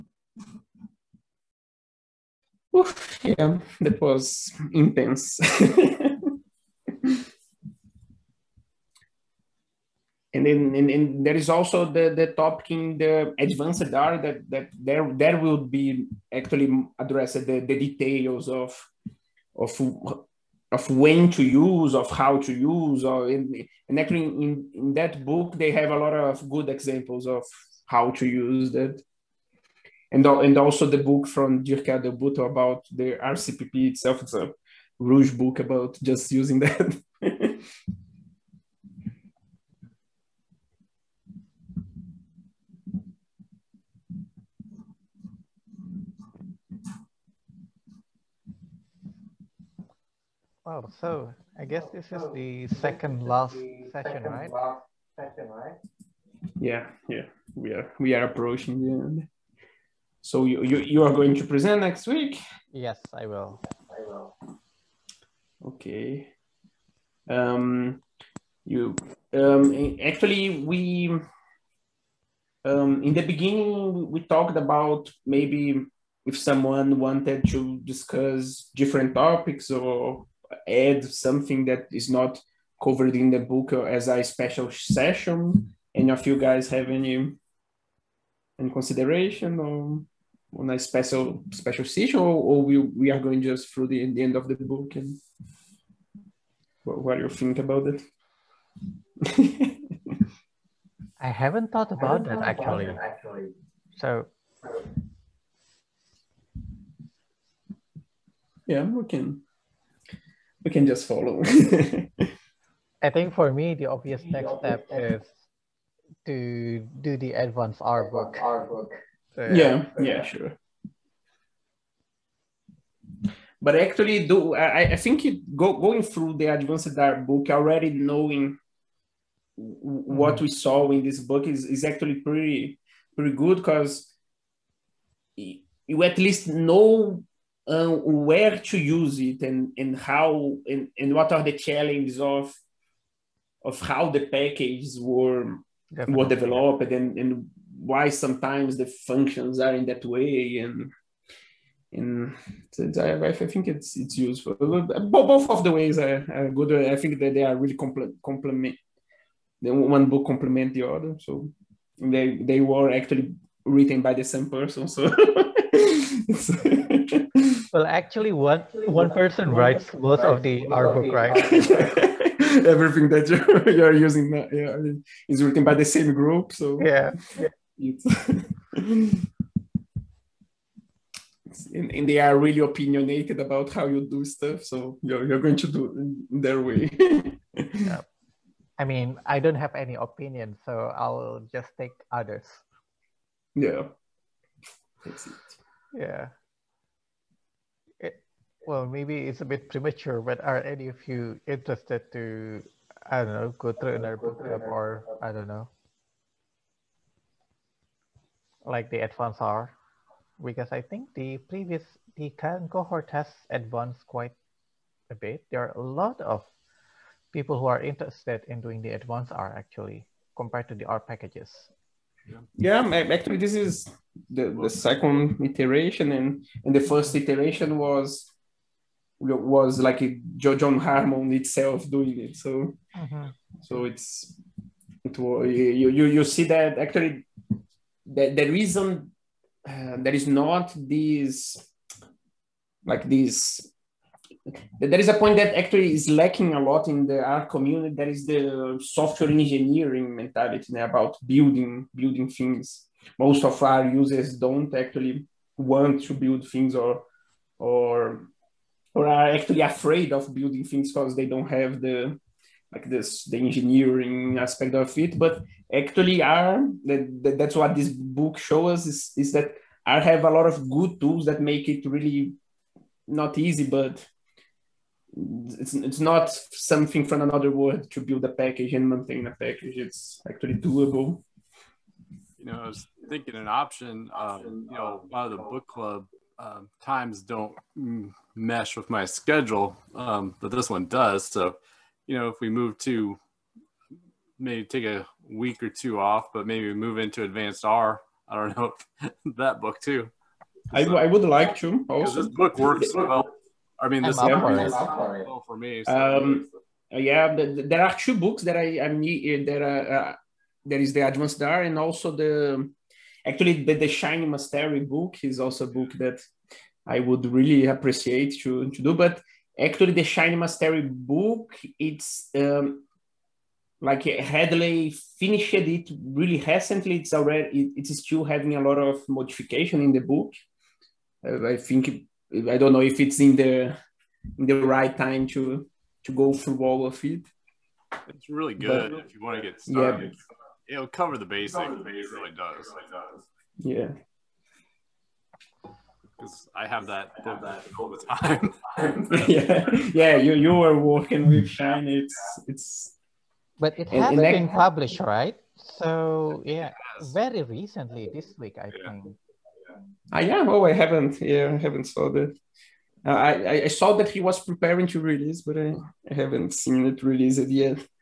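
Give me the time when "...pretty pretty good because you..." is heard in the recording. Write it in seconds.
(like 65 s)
132 s.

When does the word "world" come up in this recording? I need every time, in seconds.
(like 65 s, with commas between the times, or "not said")
277 s.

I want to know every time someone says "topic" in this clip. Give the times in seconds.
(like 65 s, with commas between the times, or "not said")
12 s, 79 s.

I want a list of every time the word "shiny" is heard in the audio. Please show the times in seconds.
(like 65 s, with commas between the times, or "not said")
313 s, 320 s, 351 s.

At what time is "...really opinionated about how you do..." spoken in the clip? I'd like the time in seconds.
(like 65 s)
182 s.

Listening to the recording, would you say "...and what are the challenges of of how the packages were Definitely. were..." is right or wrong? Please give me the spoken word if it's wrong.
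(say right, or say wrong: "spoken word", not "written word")
right.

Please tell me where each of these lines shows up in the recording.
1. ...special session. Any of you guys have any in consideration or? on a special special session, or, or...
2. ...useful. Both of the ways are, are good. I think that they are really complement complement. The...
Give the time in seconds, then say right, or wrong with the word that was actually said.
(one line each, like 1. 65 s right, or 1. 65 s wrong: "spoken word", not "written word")
1. 84 s right
2. 154 s right.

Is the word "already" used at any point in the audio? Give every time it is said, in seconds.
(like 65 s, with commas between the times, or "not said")
127 s, 327 s.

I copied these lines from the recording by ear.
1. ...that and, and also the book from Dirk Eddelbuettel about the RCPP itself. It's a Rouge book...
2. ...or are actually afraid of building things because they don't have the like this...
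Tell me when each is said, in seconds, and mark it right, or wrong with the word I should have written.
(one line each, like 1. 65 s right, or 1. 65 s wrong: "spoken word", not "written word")
1. 28 s right
2. 258 s right.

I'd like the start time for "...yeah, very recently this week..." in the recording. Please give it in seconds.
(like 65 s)
356 s.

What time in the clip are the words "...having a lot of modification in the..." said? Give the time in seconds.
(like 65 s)
328 s.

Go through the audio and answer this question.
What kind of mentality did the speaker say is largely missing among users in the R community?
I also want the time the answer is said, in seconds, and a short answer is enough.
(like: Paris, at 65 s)
software engineering mentality, at 248 s.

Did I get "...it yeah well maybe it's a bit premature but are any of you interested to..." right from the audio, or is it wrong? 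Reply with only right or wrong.
right.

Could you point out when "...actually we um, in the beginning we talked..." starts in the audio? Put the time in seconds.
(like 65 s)
70 s.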